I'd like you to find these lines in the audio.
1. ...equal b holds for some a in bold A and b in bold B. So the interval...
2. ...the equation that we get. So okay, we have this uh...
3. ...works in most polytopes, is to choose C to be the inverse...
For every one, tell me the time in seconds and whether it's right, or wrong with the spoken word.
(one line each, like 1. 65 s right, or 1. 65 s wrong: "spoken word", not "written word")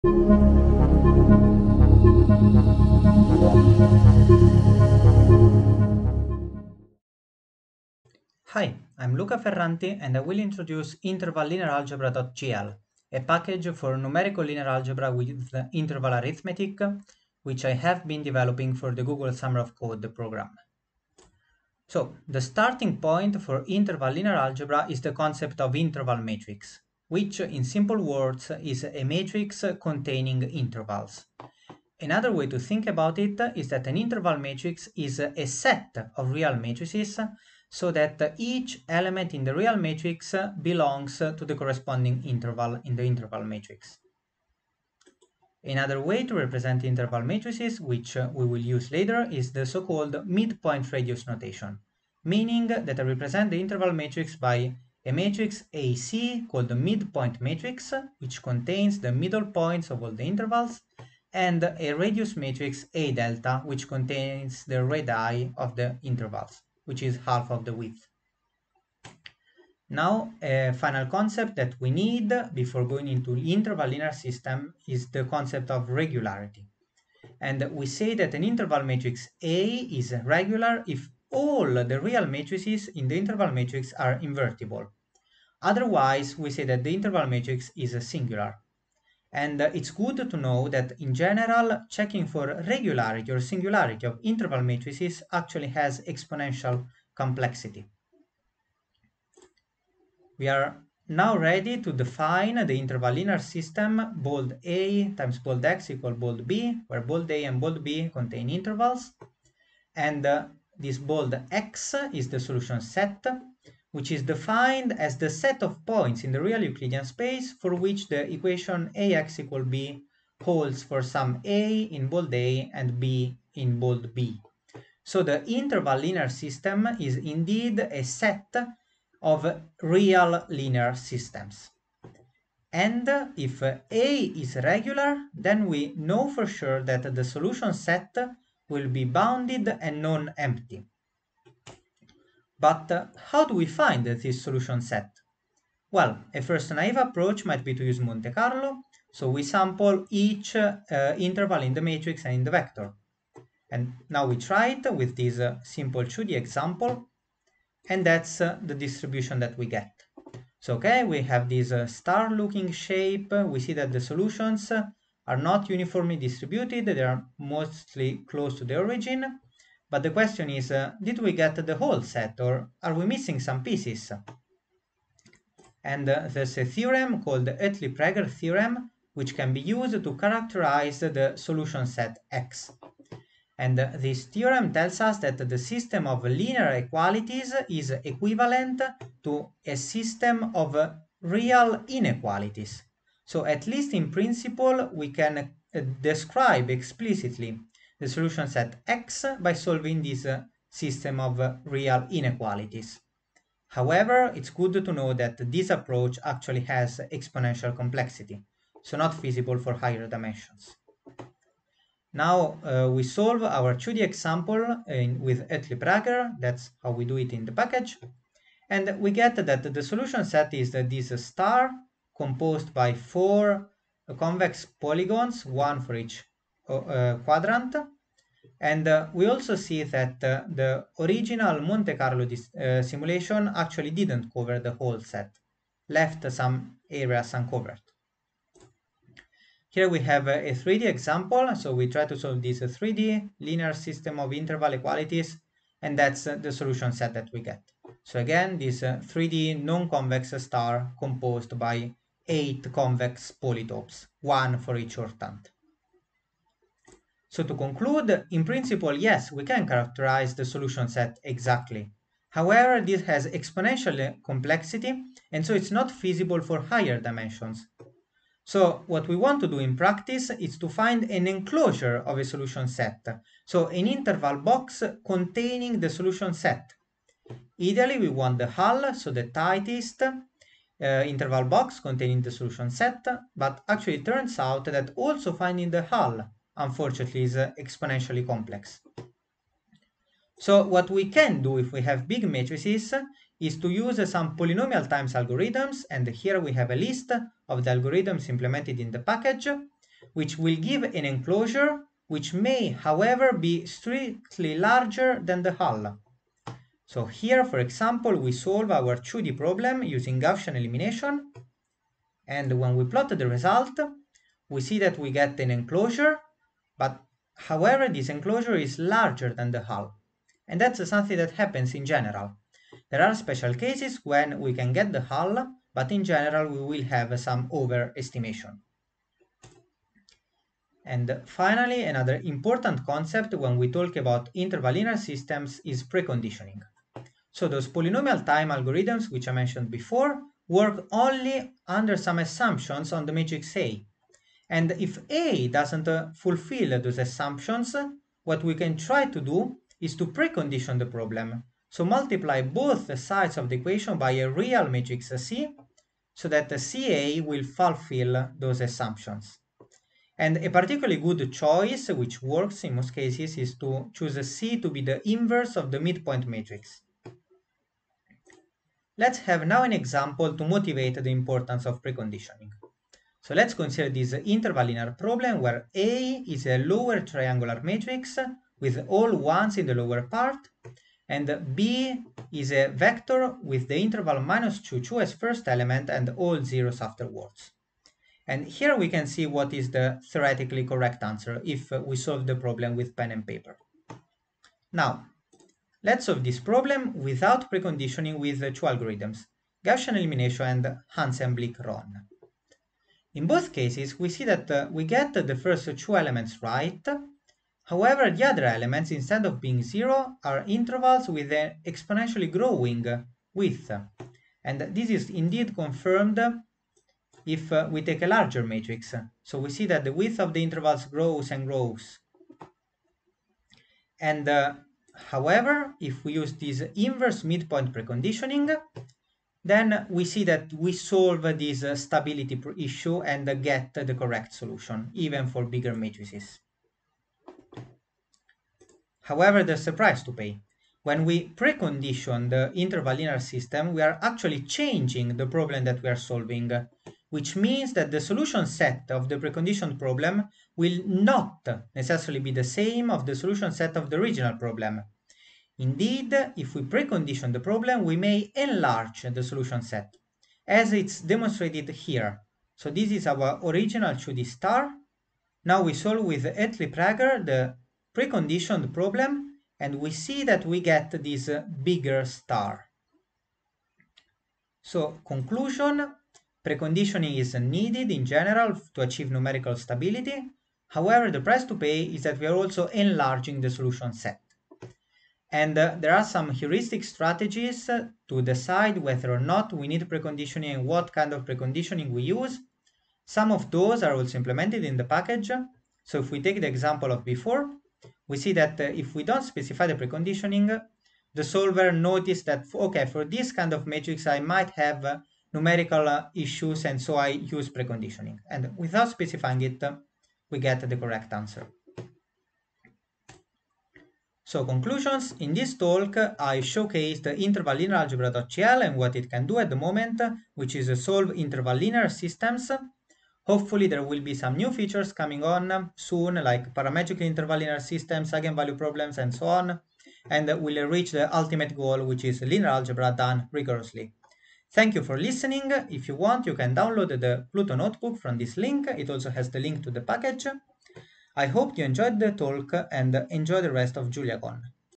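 1. 119 s right
2. 158 s wrong: "distribution", not "equation"
3. 362 s wrong: "cases", not "polytopes".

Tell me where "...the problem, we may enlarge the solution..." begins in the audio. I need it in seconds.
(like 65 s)
457 s.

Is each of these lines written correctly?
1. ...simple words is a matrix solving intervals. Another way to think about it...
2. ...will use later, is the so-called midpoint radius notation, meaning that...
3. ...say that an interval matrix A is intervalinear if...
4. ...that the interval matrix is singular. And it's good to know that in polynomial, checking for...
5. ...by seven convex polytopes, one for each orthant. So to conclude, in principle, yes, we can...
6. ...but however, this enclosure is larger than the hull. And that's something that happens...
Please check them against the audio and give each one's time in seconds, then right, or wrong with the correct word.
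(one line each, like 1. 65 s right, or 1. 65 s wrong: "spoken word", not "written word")
1. 27 s wrong: "containing", not "solving"
2. 48 s right
3. 77 s wrong: "regular", not "intervalinear"
4. 86 s wrong: "general", not "polynomial"
5. 251 s wrong: "eight", not "seven"
6. 316 s right.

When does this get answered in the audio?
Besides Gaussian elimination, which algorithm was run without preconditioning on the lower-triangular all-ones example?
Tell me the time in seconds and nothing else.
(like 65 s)
400 s.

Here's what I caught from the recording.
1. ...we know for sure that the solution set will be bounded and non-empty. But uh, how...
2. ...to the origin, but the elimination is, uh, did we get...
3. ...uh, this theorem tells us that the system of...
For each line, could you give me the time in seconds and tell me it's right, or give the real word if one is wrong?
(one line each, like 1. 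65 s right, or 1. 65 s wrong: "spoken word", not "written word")
1. 135 s right
2. 168 s wrong: "question", not "elimination"
3. 183 s right.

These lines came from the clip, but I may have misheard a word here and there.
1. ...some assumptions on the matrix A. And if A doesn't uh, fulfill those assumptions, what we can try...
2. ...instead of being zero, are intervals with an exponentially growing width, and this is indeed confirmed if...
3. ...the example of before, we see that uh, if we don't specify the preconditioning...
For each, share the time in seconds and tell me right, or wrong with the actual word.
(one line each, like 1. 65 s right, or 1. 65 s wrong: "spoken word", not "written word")
1. 341 s right
2. 408 s right
3. 496 s right.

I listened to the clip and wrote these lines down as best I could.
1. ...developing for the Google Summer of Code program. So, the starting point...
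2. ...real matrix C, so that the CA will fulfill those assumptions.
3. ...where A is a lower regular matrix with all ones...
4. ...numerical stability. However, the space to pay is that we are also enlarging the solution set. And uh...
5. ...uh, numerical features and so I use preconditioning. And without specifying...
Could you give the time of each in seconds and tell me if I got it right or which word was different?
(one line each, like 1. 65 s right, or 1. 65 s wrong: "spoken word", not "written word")
1. 18 s right
2. 354 s right
3. 375 s wrong: "triangular", not "regular"
4. 479 s wrong: "price", not "space"
5. 504 s wrong: "issues", not "features".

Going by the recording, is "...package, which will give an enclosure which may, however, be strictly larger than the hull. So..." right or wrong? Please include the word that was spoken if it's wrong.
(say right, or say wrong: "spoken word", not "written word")
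right.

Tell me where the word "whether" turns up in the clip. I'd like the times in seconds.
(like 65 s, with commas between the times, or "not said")
488 s.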